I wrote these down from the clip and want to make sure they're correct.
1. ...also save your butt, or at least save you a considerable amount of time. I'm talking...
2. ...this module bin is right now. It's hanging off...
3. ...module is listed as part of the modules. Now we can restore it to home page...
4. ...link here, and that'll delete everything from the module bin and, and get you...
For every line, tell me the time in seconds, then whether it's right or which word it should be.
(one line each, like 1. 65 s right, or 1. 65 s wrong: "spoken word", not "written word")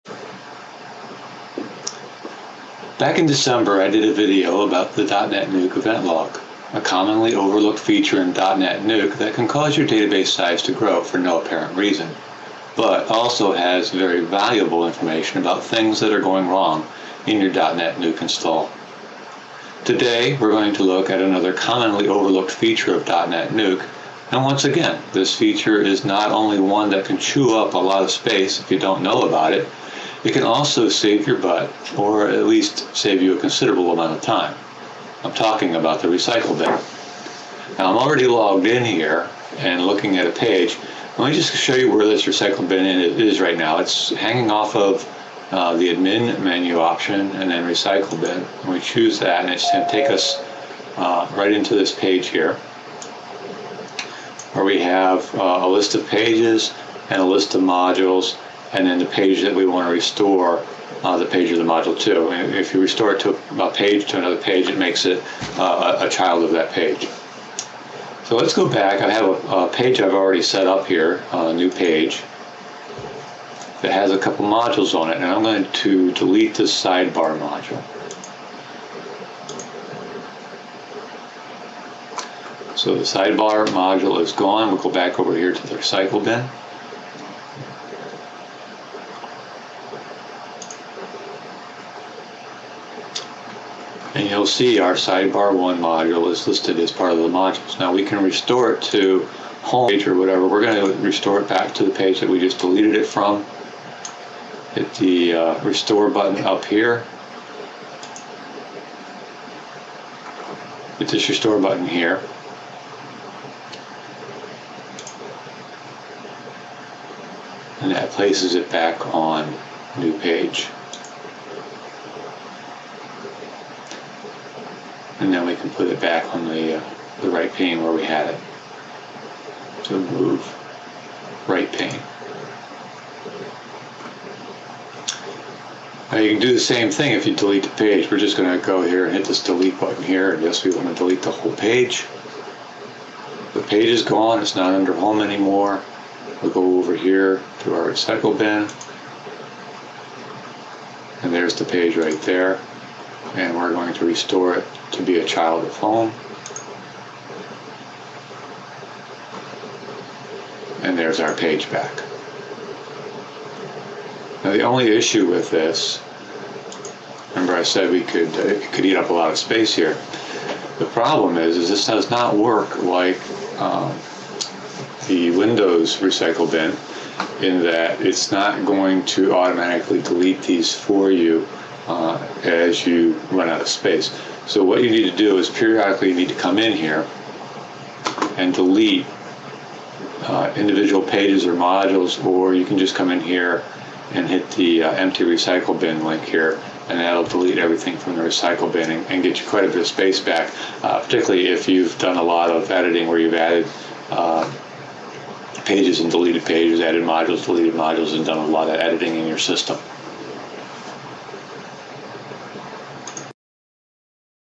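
1. 30 s right
2. 42 s wrong: "recycle", not "module"
3. 95 s right
4. 196 s wrong: "recycle", not "module".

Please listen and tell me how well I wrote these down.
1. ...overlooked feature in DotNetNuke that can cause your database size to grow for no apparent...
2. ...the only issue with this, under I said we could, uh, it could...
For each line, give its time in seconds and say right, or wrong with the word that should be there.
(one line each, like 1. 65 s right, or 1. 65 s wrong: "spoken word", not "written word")
1. 7 s right
2. 164 s wrong: "remember", not "under".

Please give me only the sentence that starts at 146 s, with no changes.
We'll go over here to our recycle bin.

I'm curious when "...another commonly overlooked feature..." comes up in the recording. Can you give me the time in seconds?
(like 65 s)
21 s.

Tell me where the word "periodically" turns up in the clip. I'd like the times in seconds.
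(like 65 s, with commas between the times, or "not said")
185 s.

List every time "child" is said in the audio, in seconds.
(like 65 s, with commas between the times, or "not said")
66 s, 155 s.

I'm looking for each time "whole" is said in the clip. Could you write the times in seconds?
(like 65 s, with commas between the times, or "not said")
141 s.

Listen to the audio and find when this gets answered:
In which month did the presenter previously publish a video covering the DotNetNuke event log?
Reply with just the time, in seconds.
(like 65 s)
3 s.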